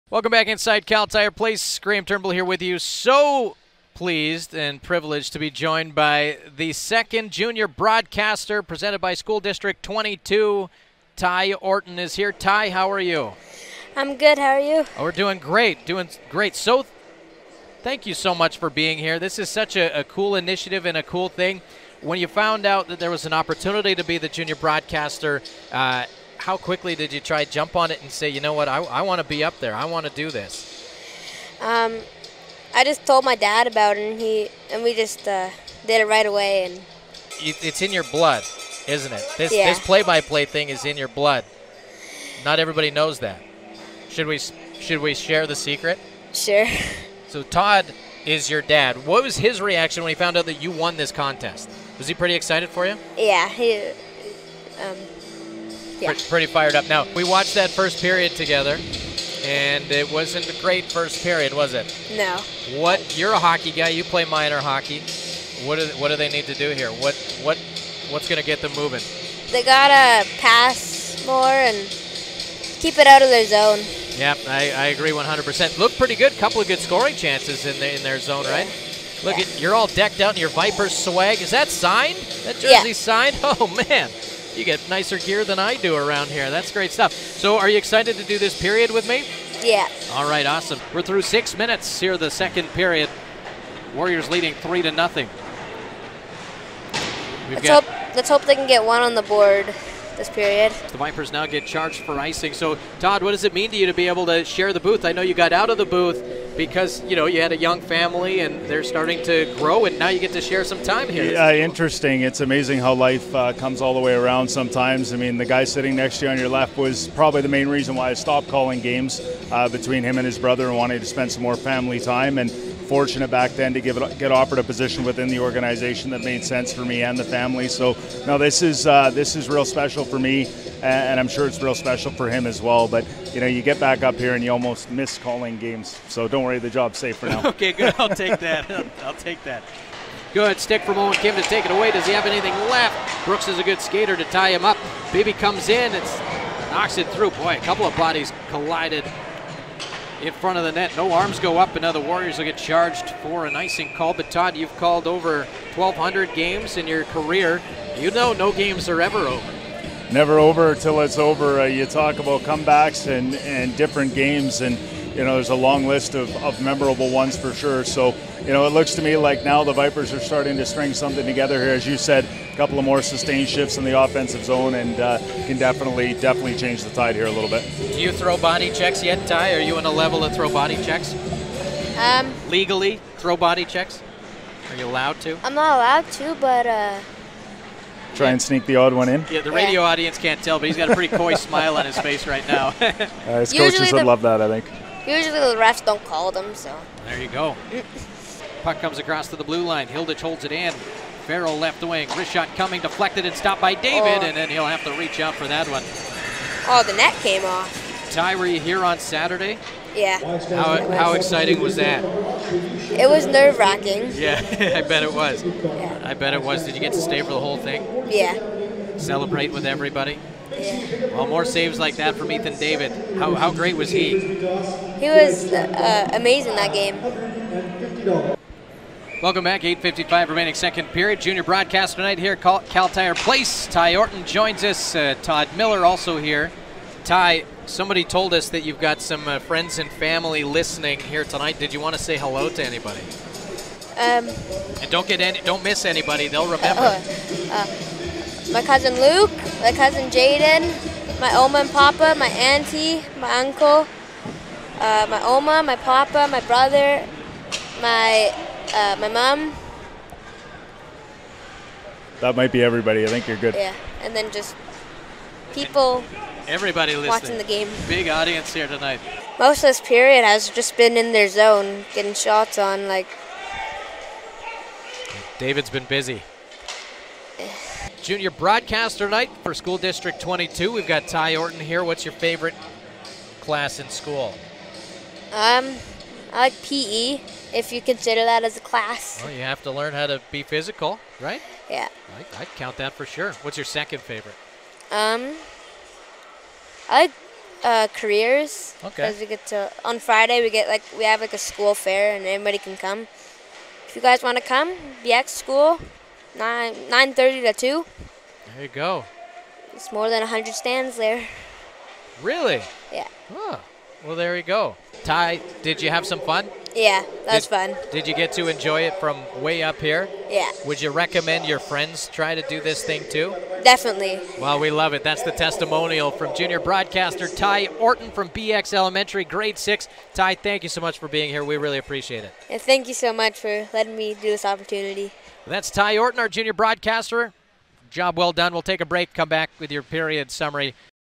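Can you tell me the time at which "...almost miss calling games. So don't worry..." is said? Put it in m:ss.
2:14.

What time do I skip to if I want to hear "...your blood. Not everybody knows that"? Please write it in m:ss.
0:40.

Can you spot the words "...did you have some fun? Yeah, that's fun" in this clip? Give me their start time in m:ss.
5:15.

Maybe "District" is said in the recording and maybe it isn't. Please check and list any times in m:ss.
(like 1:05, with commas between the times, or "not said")
0:09, 4:39.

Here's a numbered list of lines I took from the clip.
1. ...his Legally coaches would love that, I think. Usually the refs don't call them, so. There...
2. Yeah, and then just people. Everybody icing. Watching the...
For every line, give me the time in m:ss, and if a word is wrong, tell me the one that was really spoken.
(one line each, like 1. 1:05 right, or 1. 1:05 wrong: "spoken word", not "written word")
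1. 3:13 wrong: "Usually", not "Legally"
2. 4:23 wrong: "listening", not "icing".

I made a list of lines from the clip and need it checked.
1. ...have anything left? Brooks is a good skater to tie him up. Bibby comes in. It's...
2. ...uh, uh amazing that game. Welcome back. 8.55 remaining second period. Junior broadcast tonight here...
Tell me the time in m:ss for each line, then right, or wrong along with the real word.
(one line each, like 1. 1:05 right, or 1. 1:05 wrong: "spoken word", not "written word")
1. 2:22 right
2. 3:45 right.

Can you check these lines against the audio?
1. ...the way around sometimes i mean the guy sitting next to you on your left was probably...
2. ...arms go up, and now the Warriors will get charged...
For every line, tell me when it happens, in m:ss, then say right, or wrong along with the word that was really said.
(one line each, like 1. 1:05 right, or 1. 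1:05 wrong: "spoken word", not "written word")
1. 1:53 right
2. 2:31 right.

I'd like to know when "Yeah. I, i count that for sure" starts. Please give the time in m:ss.
4:51.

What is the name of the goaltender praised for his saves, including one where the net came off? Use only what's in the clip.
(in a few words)
Ethan David.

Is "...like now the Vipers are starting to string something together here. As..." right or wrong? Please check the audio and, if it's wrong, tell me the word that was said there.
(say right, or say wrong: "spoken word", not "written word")
right.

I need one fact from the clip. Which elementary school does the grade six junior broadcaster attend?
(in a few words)
BX Elementary.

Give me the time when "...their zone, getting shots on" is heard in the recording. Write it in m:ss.
4:31.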